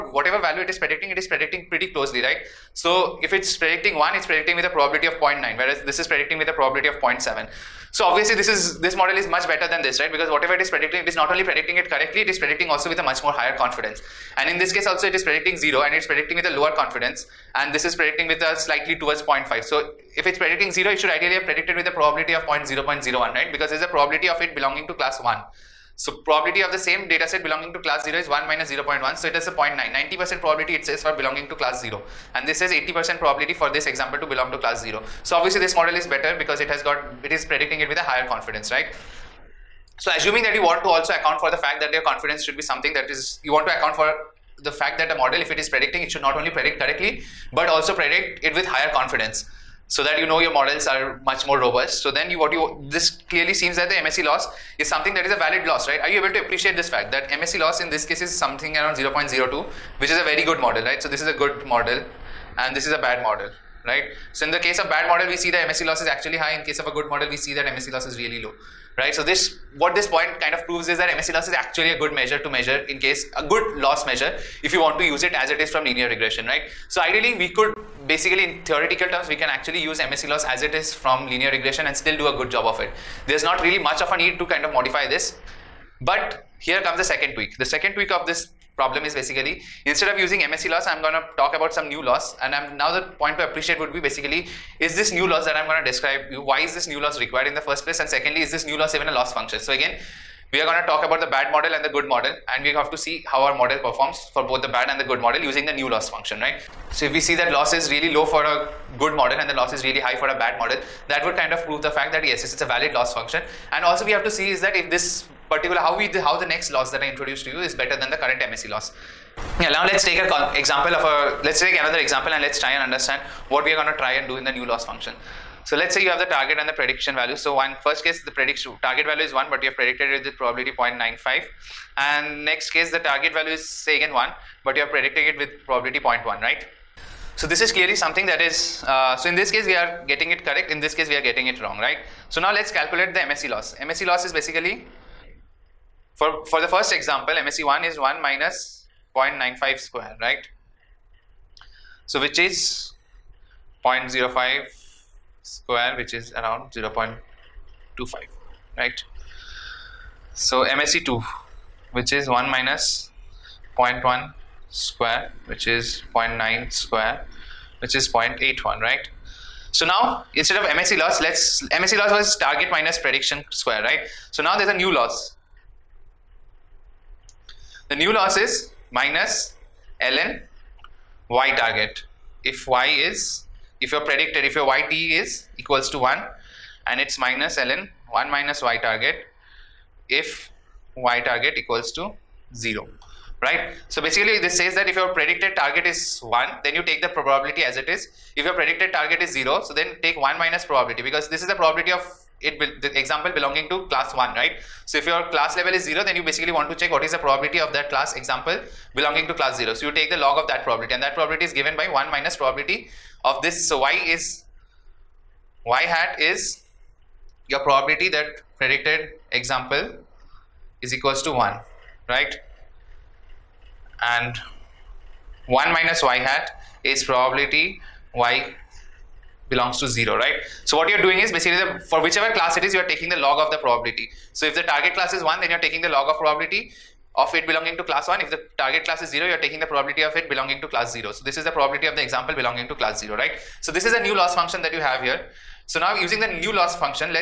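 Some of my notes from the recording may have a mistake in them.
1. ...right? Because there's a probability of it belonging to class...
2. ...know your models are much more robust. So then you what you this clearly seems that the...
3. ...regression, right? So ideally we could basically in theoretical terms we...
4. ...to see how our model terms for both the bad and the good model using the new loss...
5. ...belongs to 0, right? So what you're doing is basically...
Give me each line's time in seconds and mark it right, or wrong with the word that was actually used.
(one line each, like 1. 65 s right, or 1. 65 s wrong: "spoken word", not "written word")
1. 23 s right
2. 50 s right
3. 76 s right
4. 102 s wrong: "performs", not "terms"
5. 229 s right.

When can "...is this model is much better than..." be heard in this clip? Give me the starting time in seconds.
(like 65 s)
8 s.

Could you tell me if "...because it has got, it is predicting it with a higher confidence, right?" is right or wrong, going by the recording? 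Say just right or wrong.
right.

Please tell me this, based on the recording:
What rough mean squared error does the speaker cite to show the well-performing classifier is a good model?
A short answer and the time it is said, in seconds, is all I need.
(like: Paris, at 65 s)
0.02, at 58 s.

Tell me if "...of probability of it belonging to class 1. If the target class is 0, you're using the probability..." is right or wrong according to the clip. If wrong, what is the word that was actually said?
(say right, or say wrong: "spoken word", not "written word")
wrong: "taking", not "using".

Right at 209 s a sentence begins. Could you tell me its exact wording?
So you take the log of that probability and that probability is given by 1 minus probability of this.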